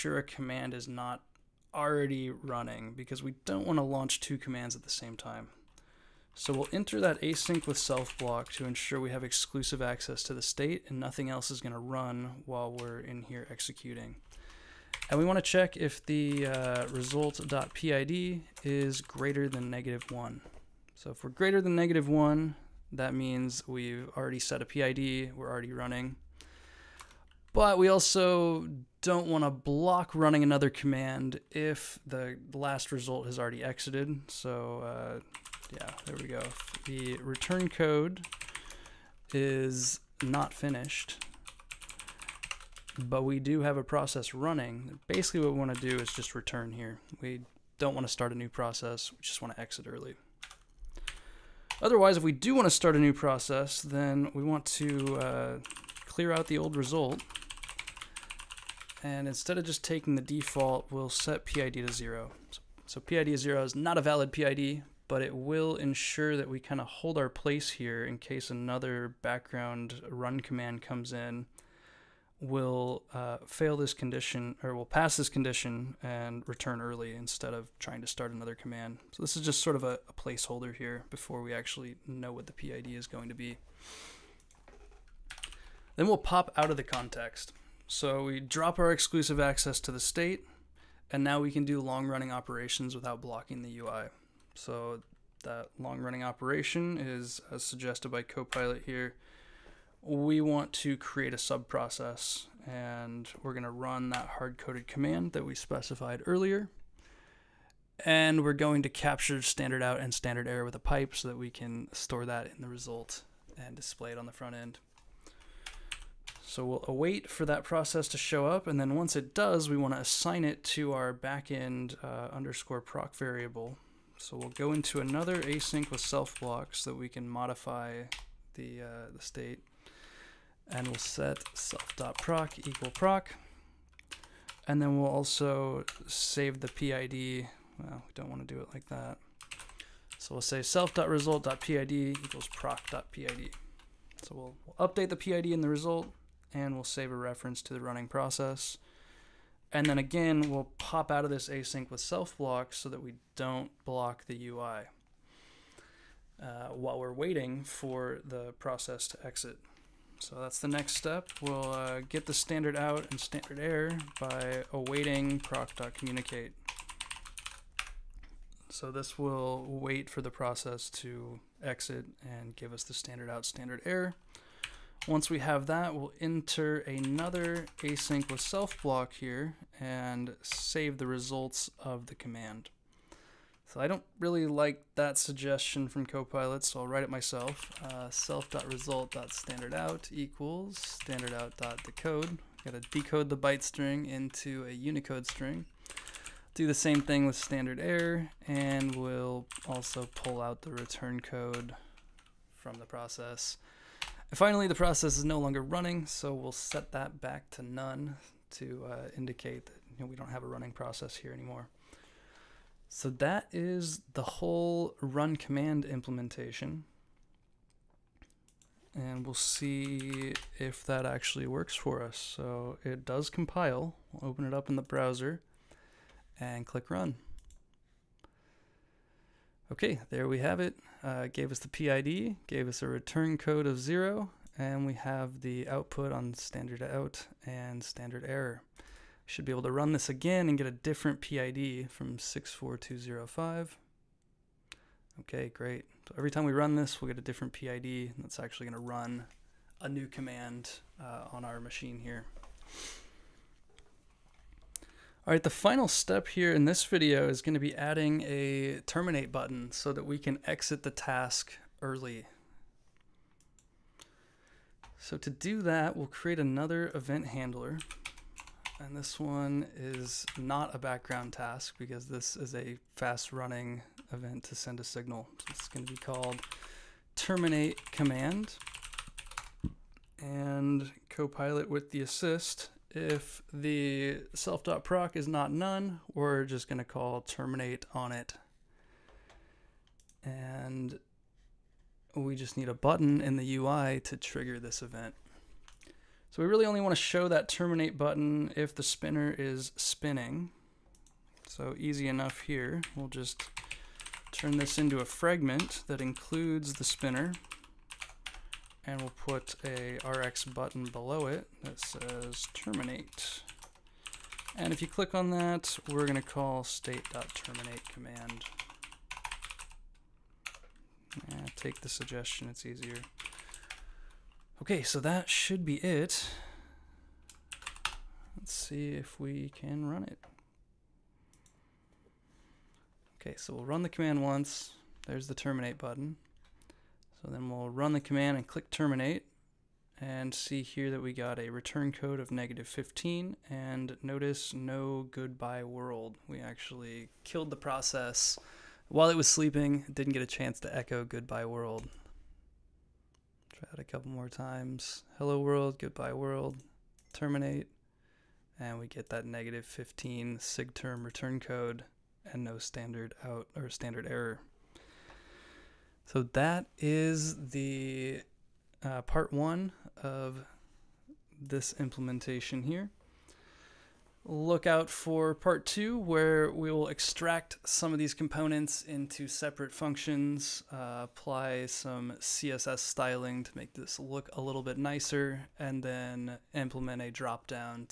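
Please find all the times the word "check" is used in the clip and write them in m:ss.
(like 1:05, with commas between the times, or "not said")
0:15.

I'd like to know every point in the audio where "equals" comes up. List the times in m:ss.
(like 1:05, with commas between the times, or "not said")
2:12, 2:21, 3:10.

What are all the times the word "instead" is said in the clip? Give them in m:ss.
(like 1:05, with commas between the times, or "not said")
0:59, 1:17.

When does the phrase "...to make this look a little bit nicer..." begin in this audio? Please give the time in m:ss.
6:23.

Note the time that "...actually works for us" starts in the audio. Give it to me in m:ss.
3:41.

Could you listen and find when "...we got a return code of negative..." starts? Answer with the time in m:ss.
5:41.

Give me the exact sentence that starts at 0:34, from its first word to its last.
So uh, yeah, there we go.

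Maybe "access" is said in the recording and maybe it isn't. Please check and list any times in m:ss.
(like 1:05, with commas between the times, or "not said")
0:09, 1:29.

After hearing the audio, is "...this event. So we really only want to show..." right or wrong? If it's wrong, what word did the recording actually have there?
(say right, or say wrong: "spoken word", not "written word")
right.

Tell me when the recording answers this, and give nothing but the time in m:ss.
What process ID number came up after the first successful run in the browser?
4:02.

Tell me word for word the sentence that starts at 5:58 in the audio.
And we get that negative 15 SIGTERM return code and no standard out or standard error.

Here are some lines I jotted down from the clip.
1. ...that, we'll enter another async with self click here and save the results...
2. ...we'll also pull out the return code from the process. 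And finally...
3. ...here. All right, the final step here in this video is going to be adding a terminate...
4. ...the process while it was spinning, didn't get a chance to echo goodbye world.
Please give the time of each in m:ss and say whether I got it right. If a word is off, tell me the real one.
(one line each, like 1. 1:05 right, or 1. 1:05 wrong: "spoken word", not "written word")
1. 2:55 wrong: "block", not "click"
2. 3:18 right
3. 4:11 right
4. 5:47 wrong: "sleeping", not "spinning".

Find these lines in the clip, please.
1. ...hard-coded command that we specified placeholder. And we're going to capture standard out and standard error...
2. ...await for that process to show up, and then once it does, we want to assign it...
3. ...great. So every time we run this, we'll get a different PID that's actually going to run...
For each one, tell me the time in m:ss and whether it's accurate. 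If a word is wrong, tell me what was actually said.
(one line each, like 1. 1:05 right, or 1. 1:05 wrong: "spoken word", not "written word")
1. 1:44 wrong: "earlier", not "placeholder"
2. 1:56 right
3. 4:05 right.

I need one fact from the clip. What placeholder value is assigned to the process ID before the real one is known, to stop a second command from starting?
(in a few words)
0.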